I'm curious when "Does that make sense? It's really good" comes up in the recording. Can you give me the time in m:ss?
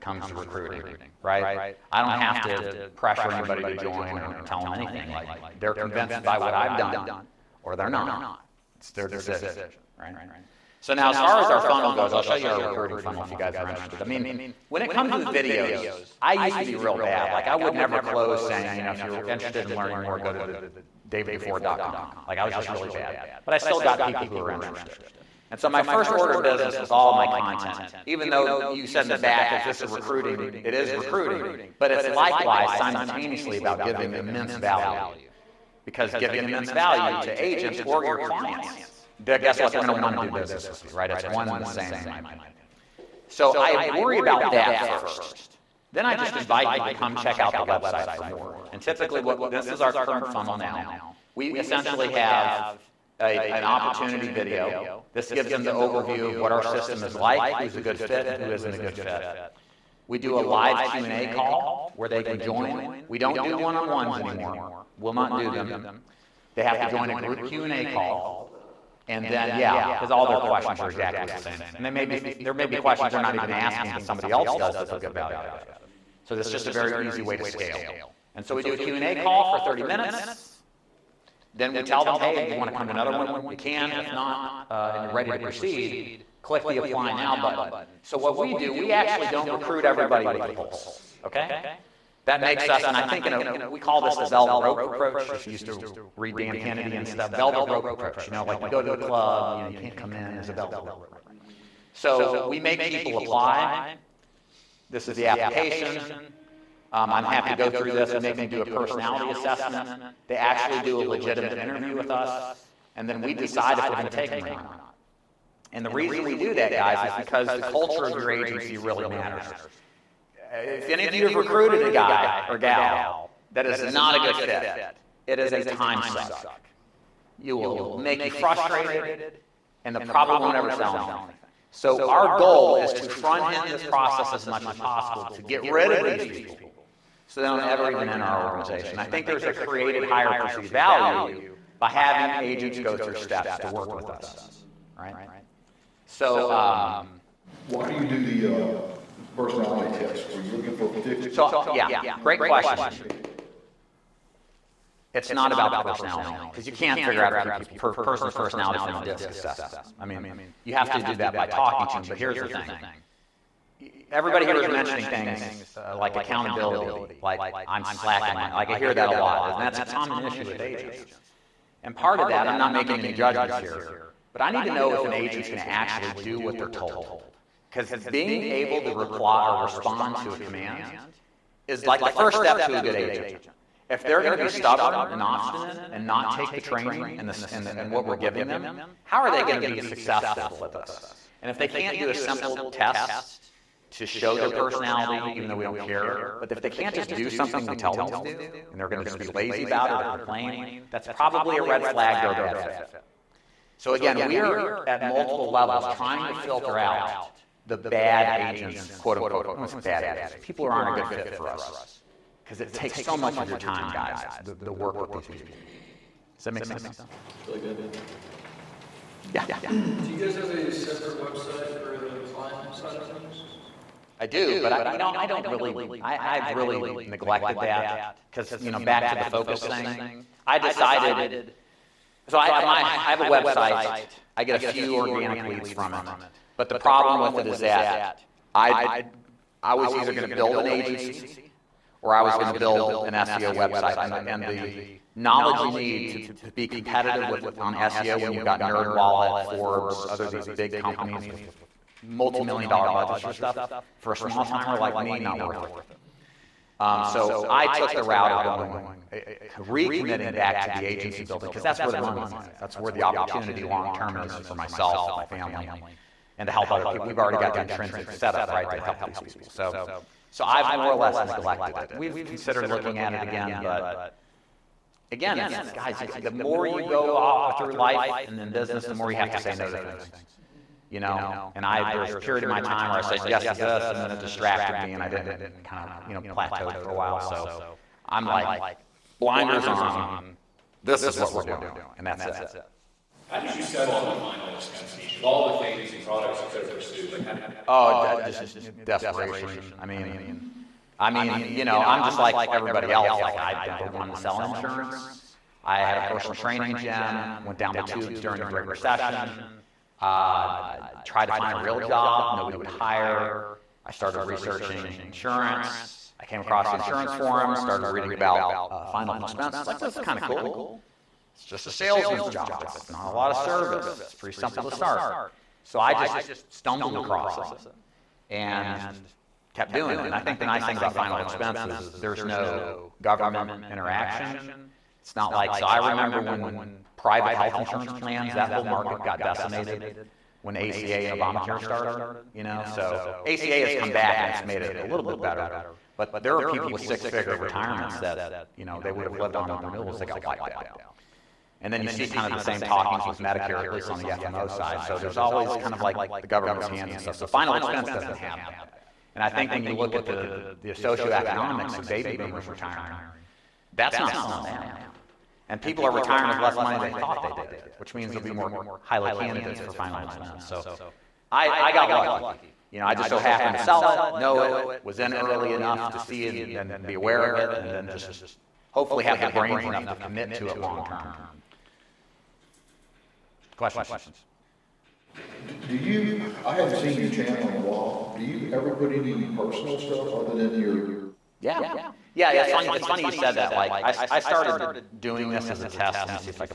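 3:36.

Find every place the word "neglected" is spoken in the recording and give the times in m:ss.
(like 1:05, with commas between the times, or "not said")
3:47, 4:31.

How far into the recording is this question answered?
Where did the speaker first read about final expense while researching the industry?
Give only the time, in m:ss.
5:16.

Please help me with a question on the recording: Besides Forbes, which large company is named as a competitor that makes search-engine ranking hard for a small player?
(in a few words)
NerdWallet.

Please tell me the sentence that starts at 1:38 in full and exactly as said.
You know, like you go to the club, you know, you can't come in, there's a velvet rope.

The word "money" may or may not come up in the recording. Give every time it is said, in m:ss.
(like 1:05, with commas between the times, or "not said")
4:21, 6:06.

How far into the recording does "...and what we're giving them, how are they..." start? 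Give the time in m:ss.
3:07.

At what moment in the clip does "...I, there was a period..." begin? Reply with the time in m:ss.
4:41.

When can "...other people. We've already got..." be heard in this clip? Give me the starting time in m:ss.
4:26.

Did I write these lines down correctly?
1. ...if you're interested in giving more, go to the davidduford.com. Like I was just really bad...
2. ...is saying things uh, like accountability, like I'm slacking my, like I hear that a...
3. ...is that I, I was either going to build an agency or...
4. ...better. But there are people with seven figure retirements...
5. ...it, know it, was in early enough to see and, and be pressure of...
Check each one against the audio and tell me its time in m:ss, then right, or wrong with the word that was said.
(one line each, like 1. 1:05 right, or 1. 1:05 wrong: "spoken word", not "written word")
1. 0:18 wrong: "learning", not "giving"
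2. 2:44 wrong: "mentioning", not "saying"
3. 3:57 right
4. 5:45 wrong: "six", not "seven"
5. 6:13 wrong: "aware", not "pressure".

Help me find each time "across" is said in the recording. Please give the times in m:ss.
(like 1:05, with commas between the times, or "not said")
5:16, 5:26.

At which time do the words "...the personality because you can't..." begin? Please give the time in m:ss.
2:35.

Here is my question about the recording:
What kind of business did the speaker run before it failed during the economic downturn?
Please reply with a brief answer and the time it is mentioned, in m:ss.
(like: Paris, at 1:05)
personal training gym, at 5:05.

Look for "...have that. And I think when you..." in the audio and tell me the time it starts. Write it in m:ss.
5:58.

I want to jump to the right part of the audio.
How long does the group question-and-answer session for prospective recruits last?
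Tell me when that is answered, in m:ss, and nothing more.
1:19.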